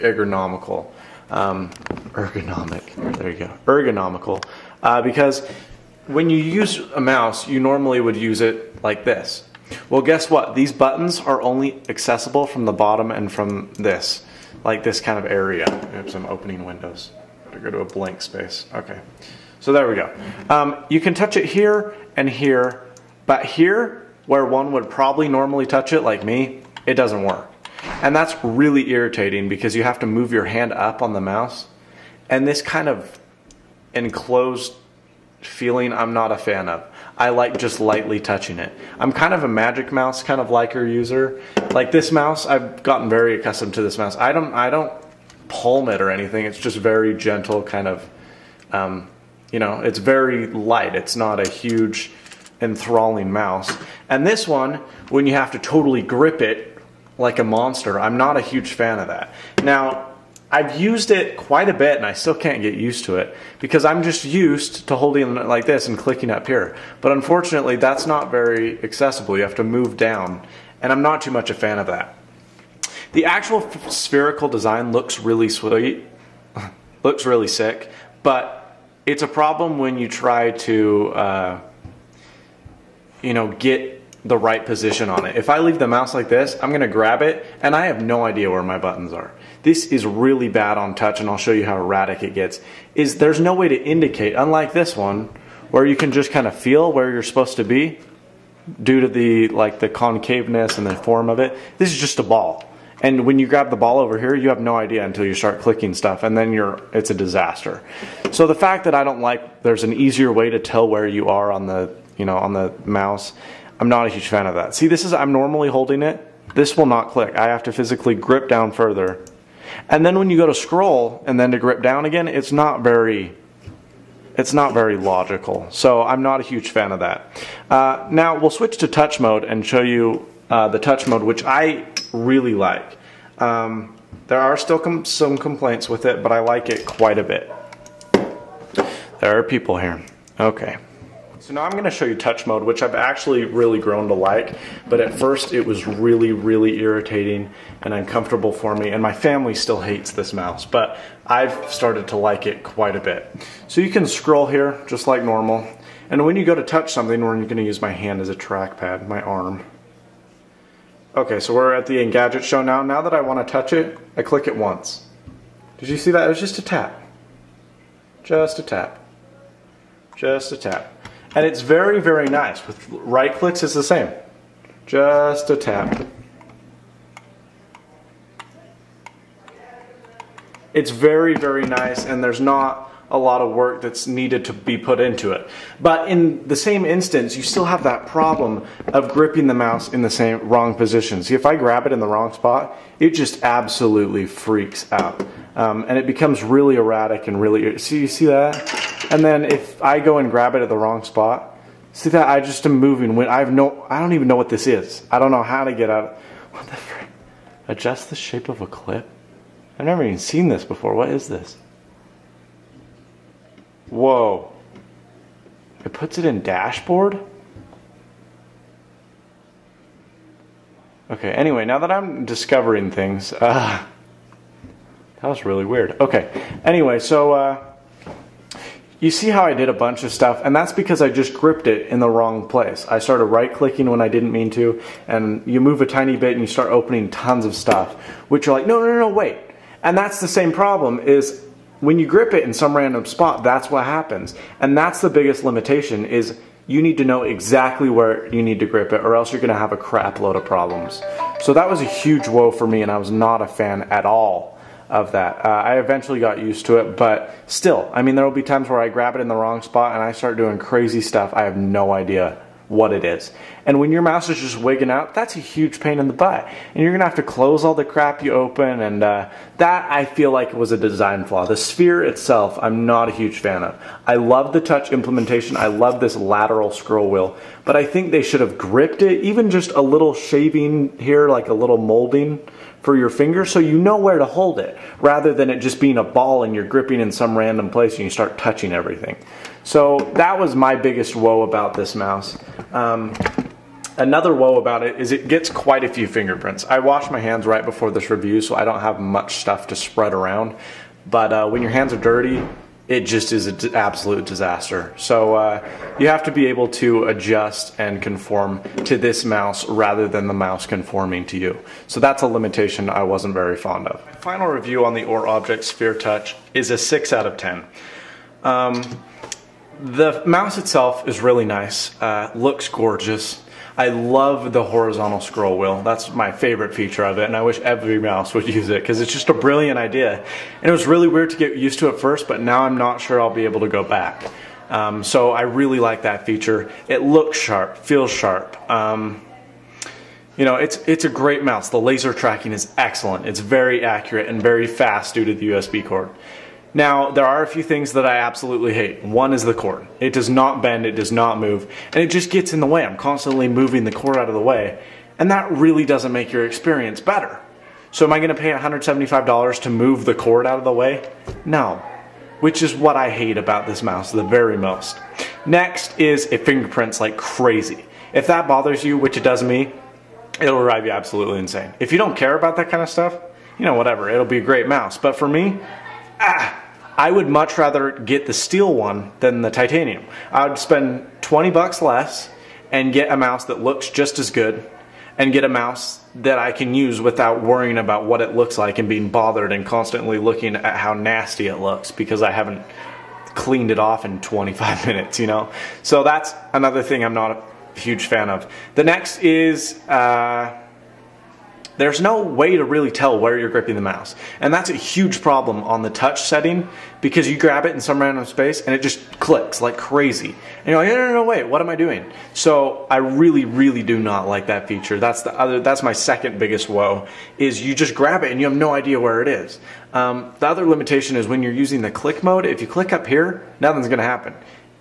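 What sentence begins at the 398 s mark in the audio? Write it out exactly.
The next is, uh, there's no way to really tell where you're gripping the mouse.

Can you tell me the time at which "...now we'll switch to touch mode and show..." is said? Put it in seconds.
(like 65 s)
128 s.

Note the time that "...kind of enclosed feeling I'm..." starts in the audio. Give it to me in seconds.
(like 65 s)
32 s.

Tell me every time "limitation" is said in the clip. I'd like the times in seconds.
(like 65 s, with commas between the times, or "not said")
245 s, 312 s, 420 s.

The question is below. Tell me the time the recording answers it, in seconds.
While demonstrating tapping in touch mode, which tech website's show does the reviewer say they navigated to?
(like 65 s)
161 s.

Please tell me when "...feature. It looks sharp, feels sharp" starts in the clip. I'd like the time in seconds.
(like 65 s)
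336 s.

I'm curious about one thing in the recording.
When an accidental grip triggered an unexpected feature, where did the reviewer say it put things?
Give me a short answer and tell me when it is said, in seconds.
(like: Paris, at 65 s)
dashboard, at 216 s.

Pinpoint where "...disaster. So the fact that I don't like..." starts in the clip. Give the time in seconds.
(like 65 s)
107 s.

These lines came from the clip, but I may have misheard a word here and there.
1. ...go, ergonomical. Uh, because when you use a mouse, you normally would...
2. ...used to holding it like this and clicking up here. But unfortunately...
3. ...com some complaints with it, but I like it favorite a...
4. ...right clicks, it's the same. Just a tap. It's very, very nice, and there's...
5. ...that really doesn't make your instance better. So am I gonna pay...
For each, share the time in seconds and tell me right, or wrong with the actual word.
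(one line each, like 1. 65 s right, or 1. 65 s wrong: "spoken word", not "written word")
1. 3 s right
2. 64 s right
3. 134 s wrong: "quite", not "favorite"
4. 172 s right
5. 355 s wrong: "experience", not "instance".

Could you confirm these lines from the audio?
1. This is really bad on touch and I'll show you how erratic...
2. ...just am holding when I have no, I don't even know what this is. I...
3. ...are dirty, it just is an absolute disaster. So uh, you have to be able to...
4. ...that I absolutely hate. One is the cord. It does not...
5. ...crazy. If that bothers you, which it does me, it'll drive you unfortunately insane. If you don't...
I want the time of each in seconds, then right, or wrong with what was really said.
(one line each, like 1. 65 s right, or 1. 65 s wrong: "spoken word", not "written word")
1. 89 s right
2. 202 s wrong: "moving", not "holding"
3. 301 s right
4. 347 s right
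5. 367 s wrong: "absolutely", not "unfortunately".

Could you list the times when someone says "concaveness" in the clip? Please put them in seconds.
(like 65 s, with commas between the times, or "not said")
99 s.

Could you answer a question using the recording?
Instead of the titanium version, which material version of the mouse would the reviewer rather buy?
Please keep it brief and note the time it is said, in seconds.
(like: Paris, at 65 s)
steel, at 378 s.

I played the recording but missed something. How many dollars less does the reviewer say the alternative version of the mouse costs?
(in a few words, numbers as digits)
20.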